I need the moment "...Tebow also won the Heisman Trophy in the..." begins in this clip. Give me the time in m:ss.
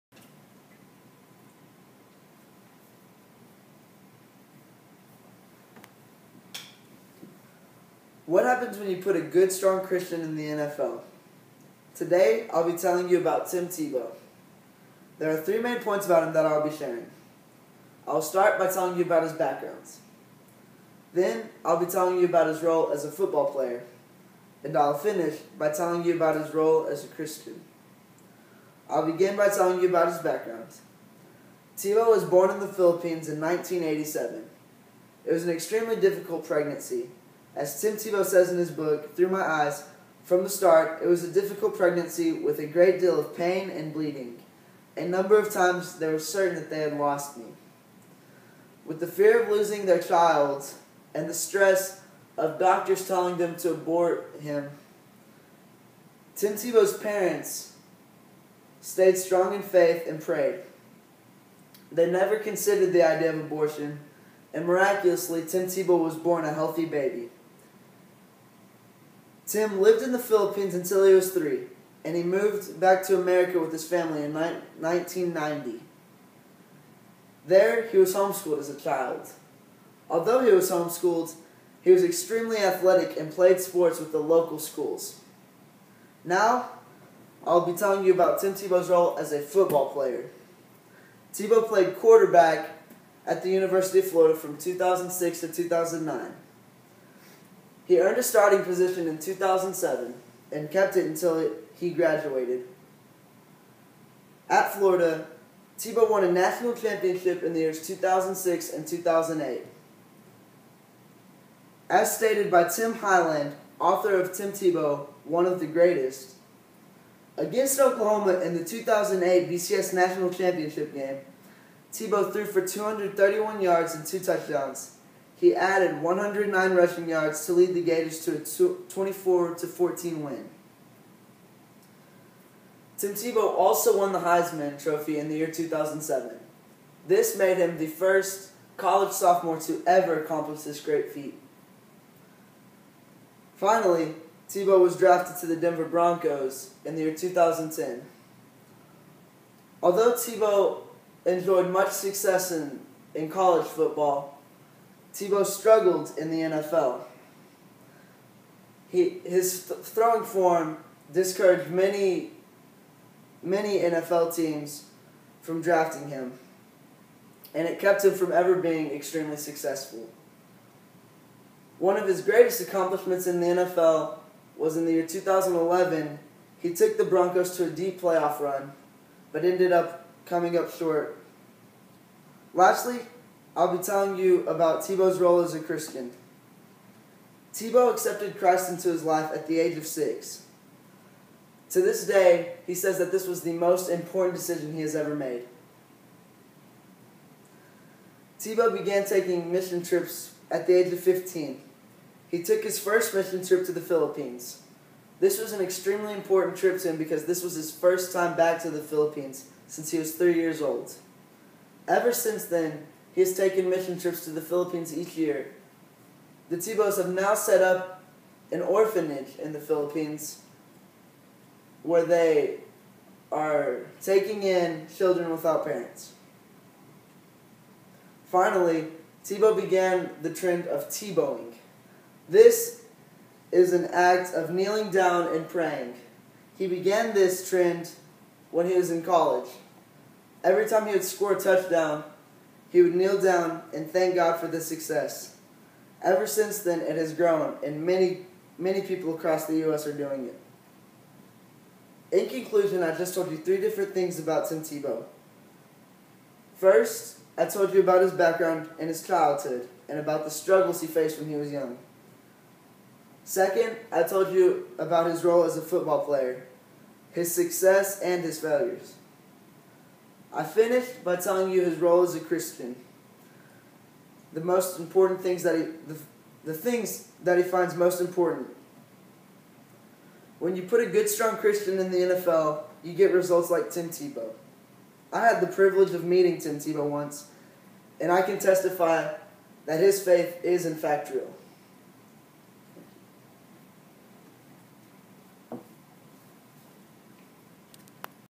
2:13.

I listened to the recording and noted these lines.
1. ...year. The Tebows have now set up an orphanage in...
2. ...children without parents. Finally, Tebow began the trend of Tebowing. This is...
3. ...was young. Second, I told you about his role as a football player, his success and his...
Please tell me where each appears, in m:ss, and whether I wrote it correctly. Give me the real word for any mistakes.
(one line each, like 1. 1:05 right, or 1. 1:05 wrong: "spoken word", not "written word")
1. 3:35 right
2. 3:44 right
3. 4:21 right.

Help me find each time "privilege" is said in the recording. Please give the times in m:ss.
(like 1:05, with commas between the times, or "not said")
4:45.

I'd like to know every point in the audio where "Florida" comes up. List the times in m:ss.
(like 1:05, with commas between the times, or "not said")
1:34, 1:44.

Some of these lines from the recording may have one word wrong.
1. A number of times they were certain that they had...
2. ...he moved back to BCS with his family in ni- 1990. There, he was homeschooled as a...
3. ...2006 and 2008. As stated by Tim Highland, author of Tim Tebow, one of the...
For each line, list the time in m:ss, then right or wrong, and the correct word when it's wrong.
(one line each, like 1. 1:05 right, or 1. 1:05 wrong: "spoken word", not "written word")
1. 0:44 right
2. 1:12 wrong: "America", not "BCS"
3. 1:47 right.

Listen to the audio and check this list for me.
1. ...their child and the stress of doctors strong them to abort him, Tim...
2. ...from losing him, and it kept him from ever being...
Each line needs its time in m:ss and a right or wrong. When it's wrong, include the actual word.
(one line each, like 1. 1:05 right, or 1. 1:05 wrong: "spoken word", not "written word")
1. 0:49 wrong: "telling", not "strong"
2. 2:45 wrong: "drafting", not "losing".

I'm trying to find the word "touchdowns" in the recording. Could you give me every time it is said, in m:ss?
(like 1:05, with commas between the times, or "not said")
2:04, 4:01.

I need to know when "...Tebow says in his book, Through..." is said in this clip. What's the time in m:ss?
0:37.